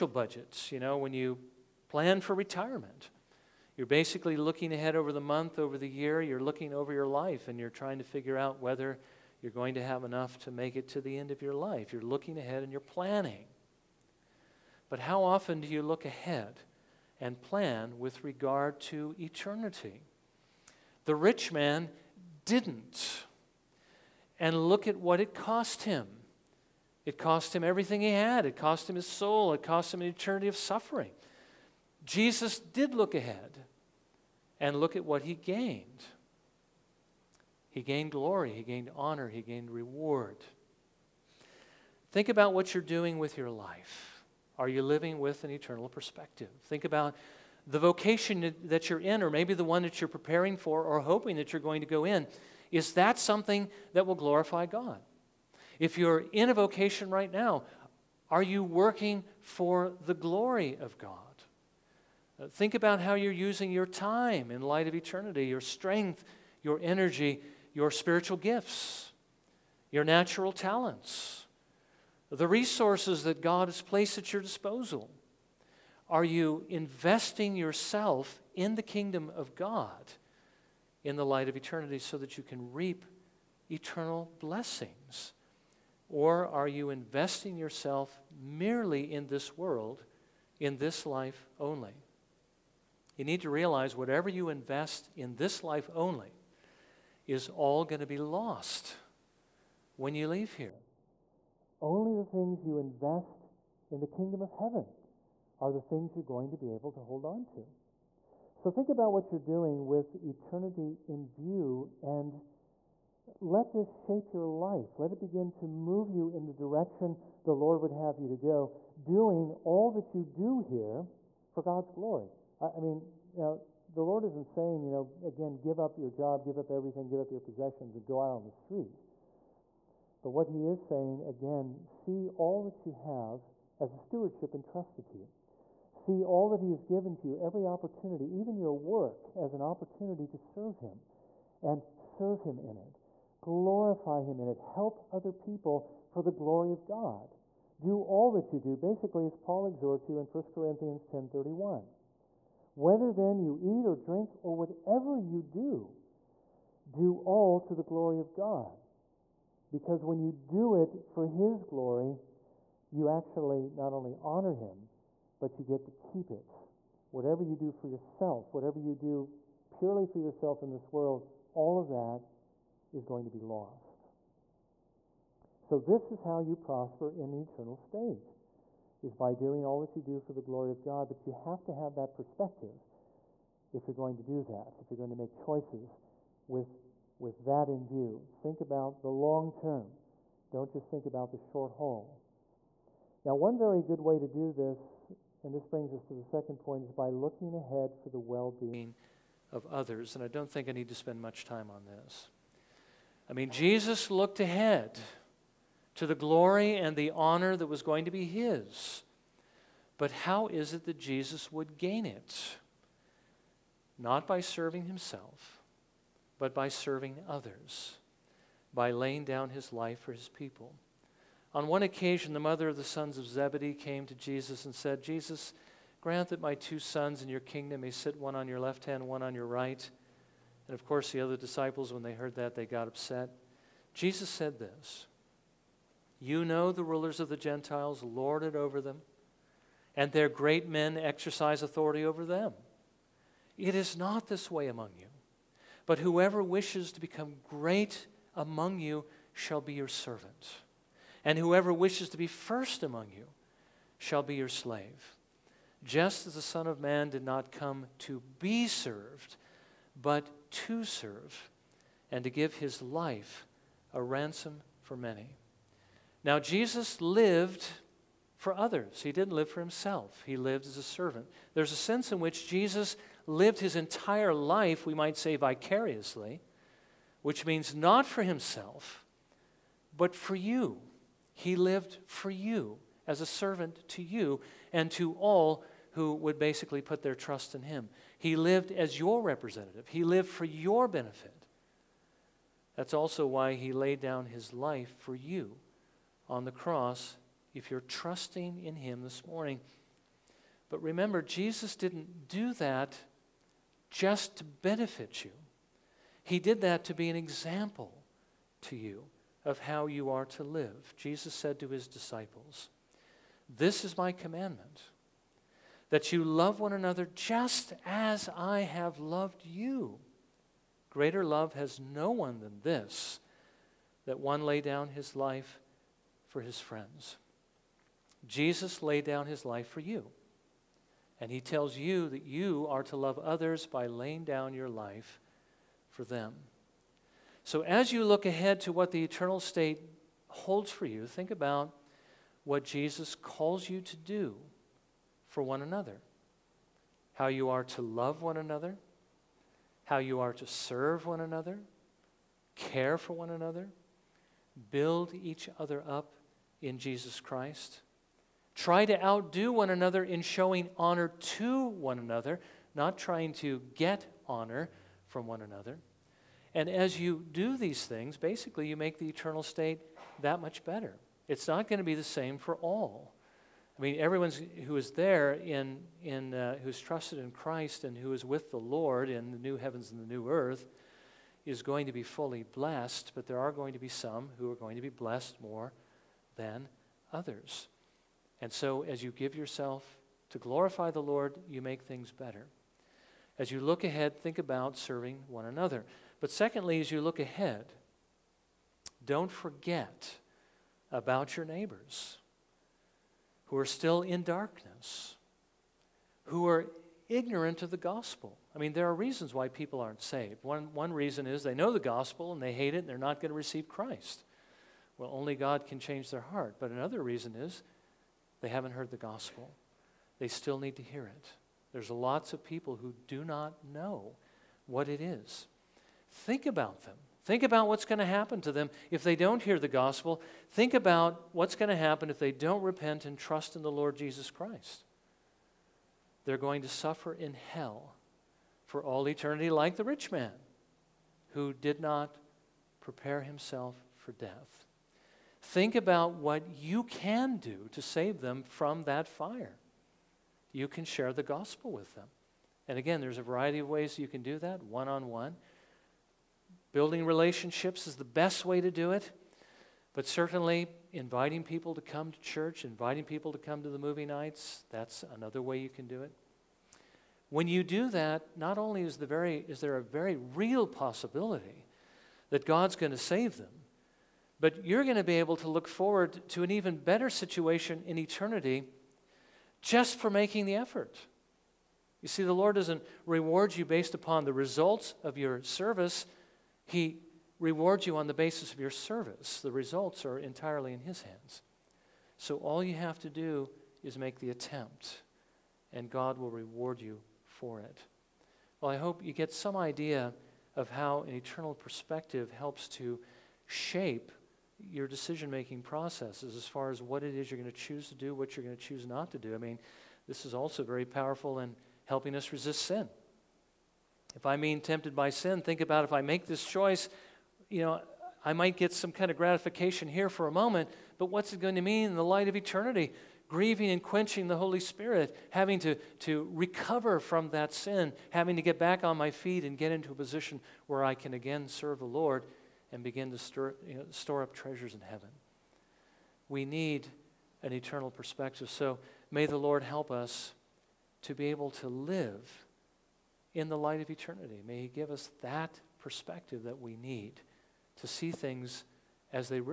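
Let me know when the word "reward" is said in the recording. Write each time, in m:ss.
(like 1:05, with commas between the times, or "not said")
0:39, 8:03, 8:07, 8:16.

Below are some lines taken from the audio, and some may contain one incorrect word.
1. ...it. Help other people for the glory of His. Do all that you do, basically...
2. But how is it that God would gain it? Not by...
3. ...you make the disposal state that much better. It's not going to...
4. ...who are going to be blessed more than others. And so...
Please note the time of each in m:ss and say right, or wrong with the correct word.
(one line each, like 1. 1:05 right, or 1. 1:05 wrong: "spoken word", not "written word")
1. 2:24 wrong: "God", not "His"
2. 3:29 wrong: "Jesus", not "God"
3. 6:08 wrong: "eternal", not "disposal"
4. 6:24 right.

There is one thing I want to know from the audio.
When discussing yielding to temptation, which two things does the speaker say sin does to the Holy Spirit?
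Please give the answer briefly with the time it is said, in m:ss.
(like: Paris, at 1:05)
Grieving and quenching, at 8:43.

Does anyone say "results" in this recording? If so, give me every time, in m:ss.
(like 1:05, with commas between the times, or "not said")
8:04, 8:09.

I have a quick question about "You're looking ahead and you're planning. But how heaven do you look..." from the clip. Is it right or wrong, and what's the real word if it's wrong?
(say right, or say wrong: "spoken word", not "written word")
wrong: "often", not "heaven".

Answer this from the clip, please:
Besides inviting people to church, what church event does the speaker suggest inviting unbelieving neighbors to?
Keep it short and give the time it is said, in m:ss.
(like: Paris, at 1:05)
Movie nights, at 7:43.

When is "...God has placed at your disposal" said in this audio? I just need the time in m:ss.
1:13.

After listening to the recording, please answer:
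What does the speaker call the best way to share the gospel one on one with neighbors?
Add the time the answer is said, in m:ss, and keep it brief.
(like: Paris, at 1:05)
Building relationships, at 7:36.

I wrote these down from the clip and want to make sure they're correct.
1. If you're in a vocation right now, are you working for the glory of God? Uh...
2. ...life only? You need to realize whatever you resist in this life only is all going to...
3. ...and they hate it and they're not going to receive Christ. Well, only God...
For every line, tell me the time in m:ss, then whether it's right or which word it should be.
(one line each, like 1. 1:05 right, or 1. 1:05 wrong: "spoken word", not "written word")
1. 0:55 right
2. 1:31 wrong: "invest", not "resist"
3. 6:52 right.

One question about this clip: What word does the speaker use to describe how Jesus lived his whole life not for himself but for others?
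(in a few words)
Vicariously.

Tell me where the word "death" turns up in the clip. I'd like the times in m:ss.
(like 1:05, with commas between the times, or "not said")
7:24.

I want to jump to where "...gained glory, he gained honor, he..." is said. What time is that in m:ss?
0:37.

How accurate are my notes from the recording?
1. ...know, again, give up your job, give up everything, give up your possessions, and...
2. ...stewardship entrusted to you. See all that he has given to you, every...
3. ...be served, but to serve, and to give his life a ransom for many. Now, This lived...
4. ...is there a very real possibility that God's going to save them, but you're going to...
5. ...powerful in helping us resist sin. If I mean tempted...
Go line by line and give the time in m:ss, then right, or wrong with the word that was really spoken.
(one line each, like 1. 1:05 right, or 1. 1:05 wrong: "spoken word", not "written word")
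1. 2:04 right
2. 2:13 right
3. 4:18 wrong: "Jesus", not "This"
4. 7:49 right
5. 8:30 right.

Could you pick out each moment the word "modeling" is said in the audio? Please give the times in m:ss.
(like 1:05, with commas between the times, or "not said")
not said.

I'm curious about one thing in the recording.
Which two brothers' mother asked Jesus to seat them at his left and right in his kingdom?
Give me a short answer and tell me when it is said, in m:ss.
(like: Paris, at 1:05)
The sons of Zebedee, at 3:42.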